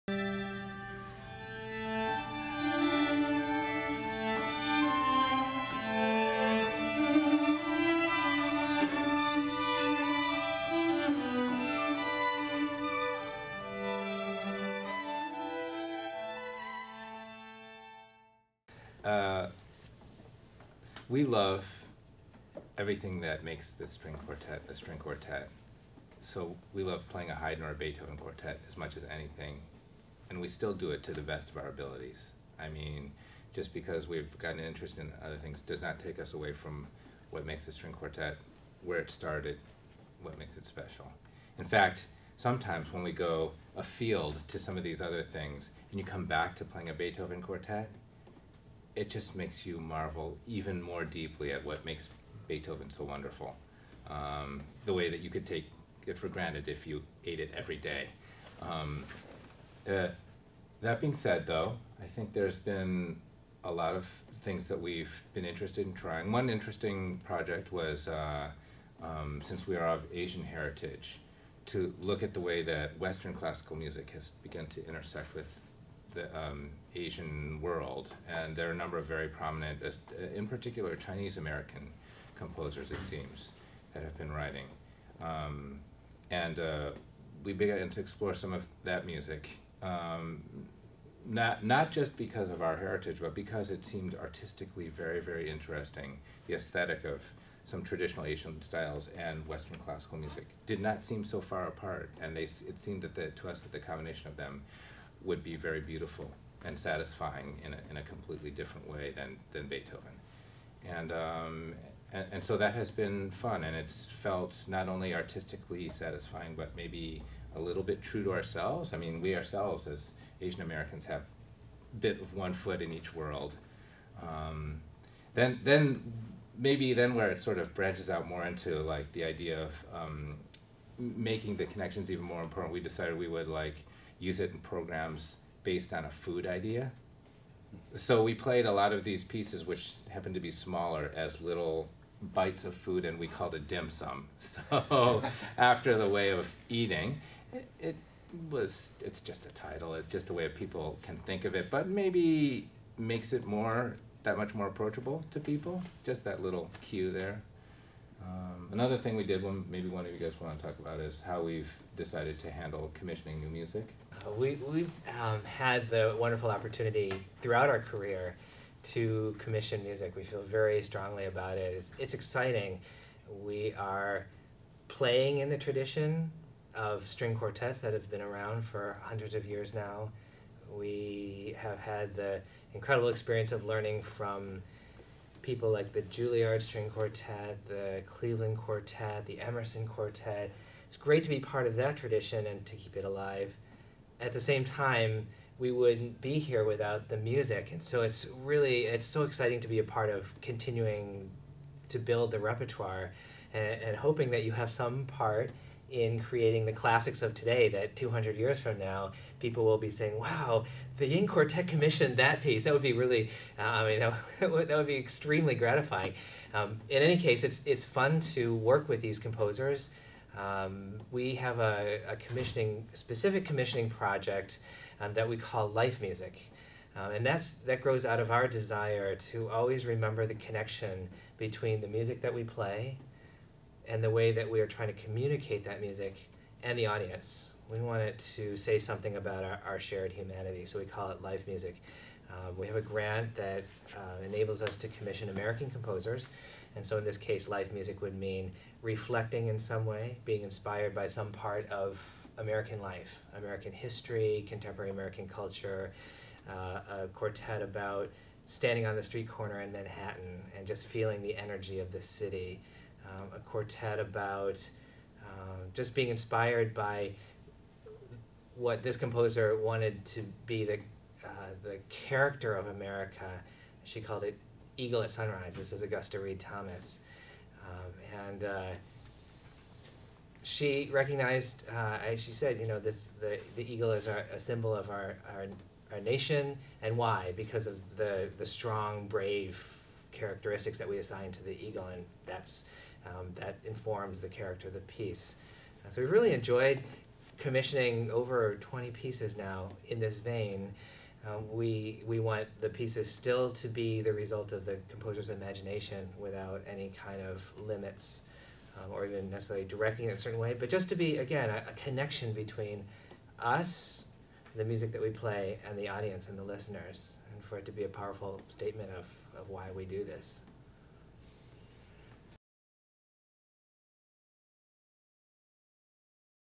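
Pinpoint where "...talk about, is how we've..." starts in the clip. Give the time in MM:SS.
02:40.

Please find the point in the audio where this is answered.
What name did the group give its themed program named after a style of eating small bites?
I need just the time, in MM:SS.
02:23.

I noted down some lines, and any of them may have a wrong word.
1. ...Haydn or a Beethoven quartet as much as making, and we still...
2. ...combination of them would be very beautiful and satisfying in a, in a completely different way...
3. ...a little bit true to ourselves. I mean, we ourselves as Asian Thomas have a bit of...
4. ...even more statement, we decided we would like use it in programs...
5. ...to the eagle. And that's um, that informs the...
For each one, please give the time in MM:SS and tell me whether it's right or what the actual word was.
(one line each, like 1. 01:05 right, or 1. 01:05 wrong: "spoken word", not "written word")
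1. 00:27 wrong: "anything", not "making"
2. 01:43 right
3. 01:57 wrong: "Americans", not "Thomas"
4. 02:12 wrong: "important", not "statement"
5. 04:51 right.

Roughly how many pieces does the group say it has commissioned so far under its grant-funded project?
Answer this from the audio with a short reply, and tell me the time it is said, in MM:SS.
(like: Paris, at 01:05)
Over 20, at 04:58.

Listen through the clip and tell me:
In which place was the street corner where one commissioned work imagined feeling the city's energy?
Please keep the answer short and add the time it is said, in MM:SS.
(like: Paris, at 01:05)
Manhattan, at 04:19.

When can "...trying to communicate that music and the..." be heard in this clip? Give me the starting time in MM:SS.
03:54.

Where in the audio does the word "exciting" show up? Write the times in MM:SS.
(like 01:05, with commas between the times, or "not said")
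02:52, 03:19.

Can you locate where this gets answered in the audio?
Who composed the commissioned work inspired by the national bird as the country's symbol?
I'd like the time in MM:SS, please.
04:35.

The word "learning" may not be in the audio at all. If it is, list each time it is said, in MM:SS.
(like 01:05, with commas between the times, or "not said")
03:03.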